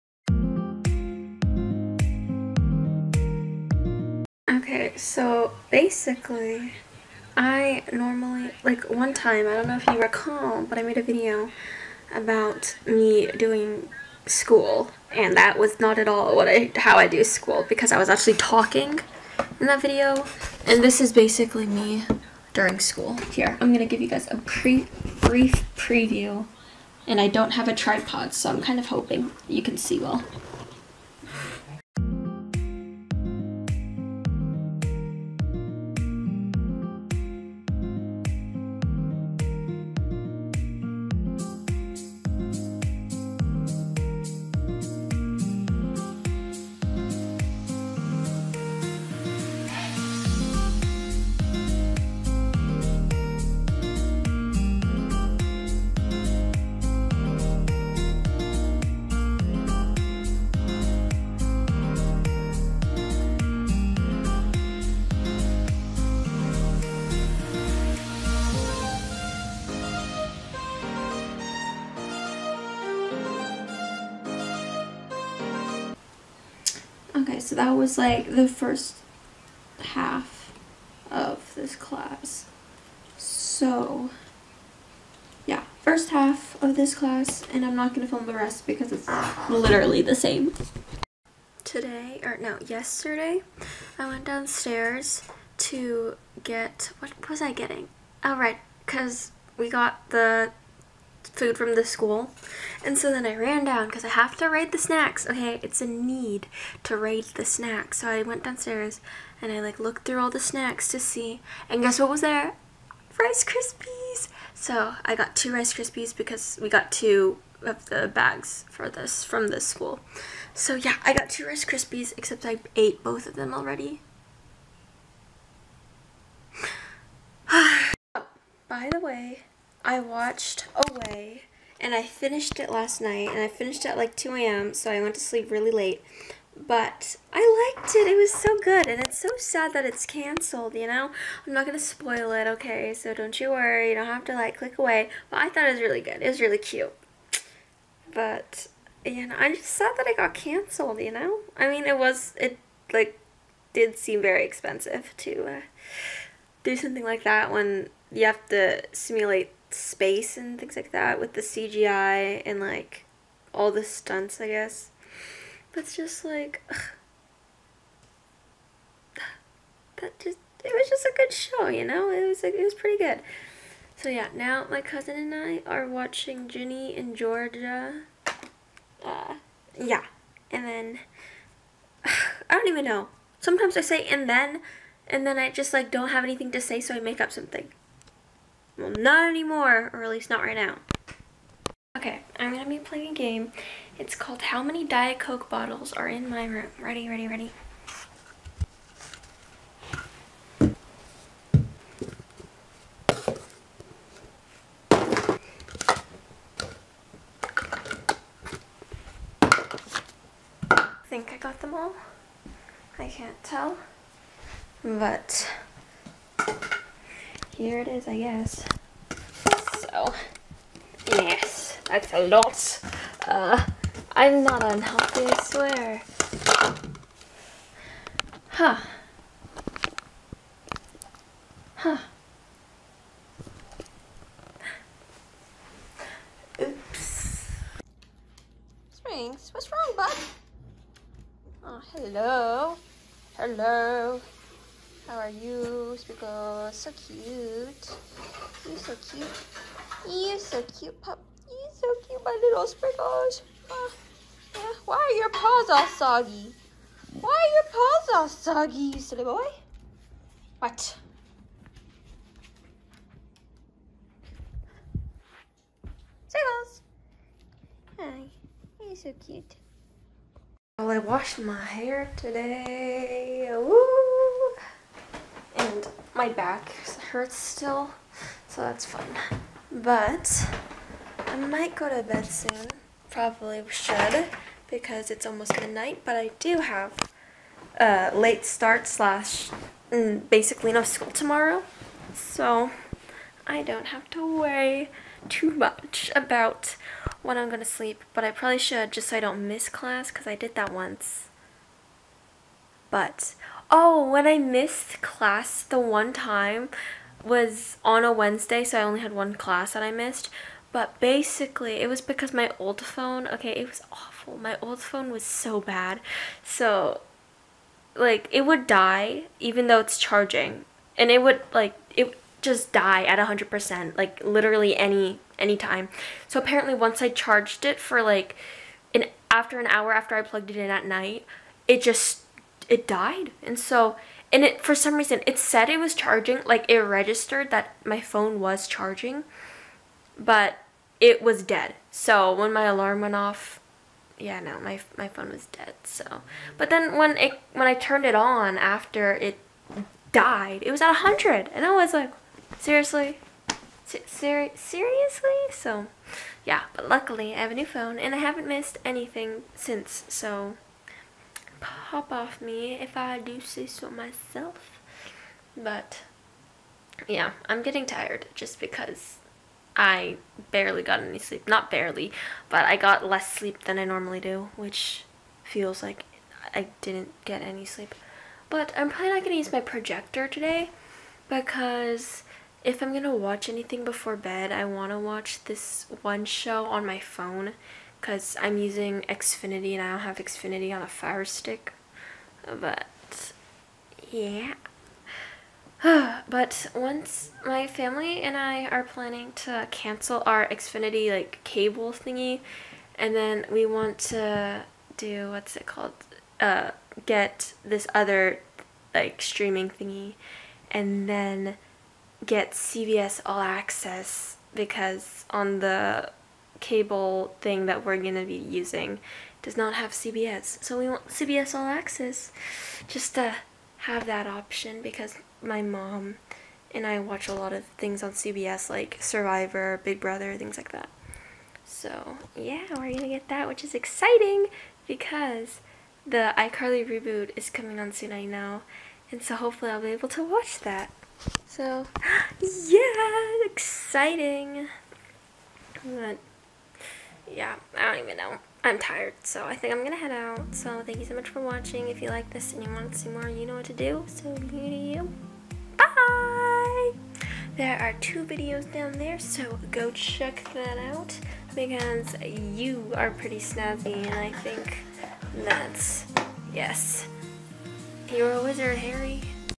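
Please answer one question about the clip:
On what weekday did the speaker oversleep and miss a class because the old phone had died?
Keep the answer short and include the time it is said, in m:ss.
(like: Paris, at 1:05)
Wednesday, at 5:08.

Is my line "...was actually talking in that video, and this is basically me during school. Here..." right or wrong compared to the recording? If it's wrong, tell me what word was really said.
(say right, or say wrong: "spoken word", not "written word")
right.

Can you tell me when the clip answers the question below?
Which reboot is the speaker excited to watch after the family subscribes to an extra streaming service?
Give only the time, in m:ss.
7:16.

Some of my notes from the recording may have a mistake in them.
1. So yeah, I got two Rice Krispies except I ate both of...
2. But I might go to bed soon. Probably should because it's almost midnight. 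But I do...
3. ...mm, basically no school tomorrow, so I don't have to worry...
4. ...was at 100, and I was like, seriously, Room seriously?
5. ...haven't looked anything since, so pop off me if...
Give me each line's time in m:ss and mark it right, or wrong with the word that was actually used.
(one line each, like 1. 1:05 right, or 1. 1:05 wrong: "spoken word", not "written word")
1. 2:00 right
2. 4:39 right
3. 4:49 right
4. 5:50 wrong: "Ser", not "Room"
5. 5:58 wrong: "missed", not "looked".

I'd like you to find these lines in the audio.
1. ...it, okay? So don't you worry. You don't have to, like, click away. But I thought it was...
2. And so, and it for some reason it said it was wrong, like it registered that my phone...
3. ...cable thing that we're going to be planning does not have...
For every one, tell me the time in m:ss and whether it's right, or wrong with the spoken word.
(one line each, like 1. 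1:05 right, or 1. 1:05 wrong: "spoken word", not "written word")
1. 2:22 right
2. 5:33 wrong: "charging", not "wrong"
3. 6:56 wrong: "using", not "planning".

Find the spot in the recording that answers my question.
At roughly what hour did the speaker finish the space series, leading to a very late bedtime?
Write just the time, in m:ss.
2:14.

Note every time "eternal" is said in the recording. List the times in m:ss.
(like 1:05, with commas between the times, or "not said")
not said.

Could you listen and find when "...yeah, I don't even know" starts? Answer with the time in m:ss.
7:27.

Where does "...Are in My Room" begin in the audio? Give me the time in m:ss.
3:15.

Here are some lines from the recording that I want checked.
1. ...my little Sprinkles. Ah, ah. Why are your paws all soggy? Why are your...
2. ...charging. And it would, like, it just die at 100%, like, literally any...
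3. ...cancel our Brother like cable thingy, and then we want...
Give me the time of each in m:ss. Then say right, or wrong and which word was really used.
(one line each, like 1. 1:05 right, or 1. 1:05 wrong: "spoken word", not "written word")
1. 4:12 right
2. 5:19 right
3. 6:39 wrong: "Xfinity", not "Brother".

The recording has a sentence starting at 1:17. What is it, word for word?
so that was like the first half of this class.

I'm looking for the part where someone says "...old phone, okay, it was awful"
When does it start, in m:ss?
5:12.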